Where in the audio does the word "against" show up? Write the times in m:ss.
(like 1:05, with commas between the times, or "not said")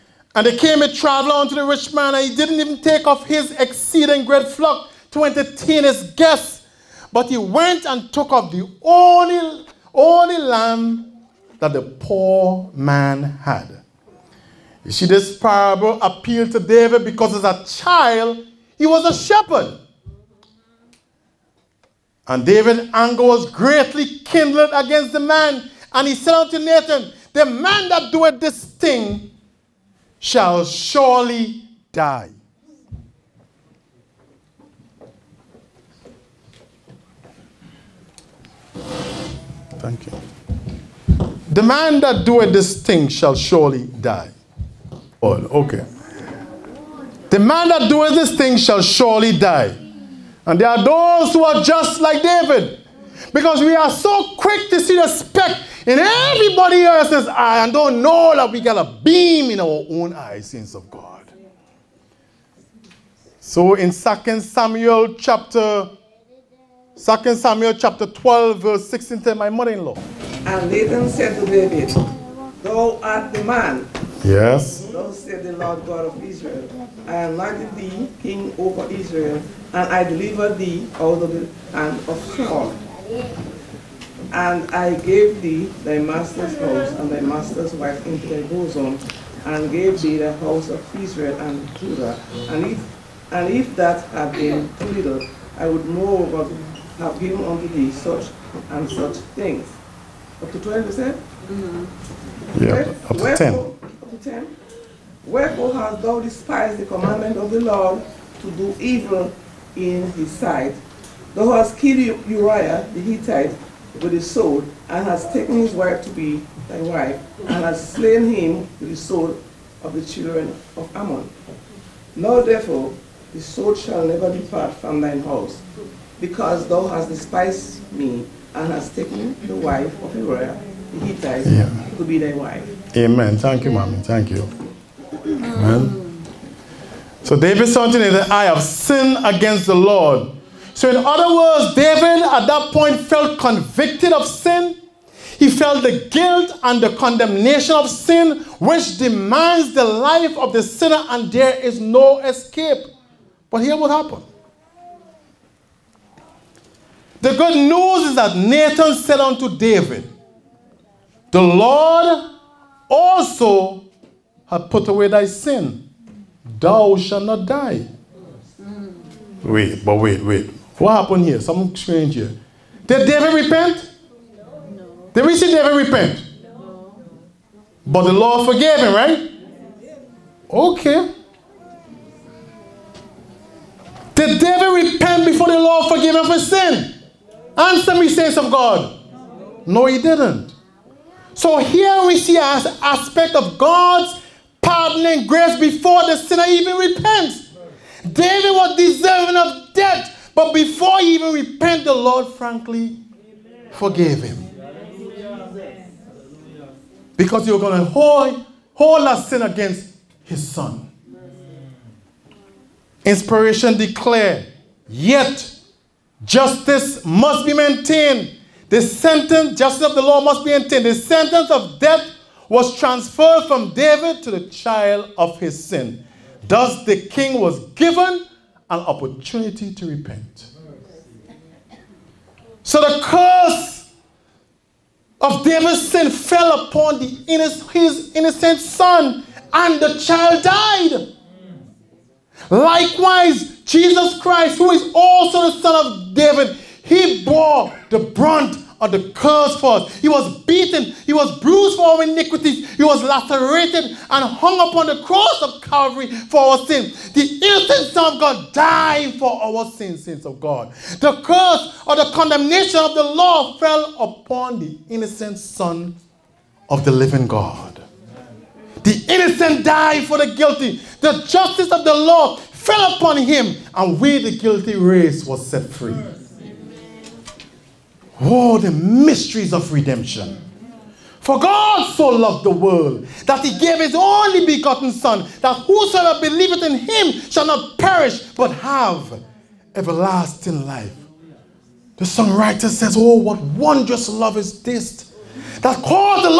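0:24, 2:19, 3:29.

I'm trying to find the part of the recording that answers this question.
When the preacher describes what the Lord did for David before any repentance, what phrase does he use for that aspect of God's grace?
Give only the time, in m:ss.
3:14.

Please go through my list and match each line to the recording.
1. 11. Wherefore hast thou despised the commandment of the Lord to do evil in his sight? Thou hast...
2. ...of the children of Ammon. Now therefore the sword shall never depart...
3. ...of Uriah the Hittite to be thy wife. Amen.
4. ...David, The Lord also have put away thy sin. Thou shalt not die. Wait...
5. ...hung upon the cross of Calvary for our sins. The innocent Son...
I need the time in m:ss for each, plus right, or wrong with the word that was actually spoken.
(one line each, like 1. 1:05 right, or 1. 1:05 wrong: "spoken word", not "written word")
1. 1:44 wrong: "10", not "11"
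2. 1:59 right
3. 2:10 right
4. 2:39 right
5. 4:14 right.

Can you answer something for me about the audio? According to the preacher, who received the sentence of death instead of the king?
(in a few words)
the child of his sin.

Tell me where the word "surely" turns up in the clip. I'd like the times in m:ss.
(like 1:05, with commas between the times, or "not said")
0:30, 0:43, 0:48.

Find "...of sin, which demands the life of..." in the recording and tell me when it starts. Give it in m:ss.
2:27.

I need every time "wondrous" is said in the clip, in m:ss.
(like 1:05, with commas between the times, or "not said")
4:53.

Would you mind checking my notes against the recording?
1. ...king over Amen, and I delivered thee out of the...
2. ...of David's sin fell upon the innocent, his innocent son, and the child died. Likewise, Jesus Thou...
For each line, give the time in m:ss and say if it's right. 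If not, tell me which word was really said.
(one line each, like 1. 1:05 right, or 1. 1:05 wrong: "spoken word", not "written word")
1. 1:18 wrong: "Israel", not "Amen"
2. 3:55 wrong: "Christ", not "Thou".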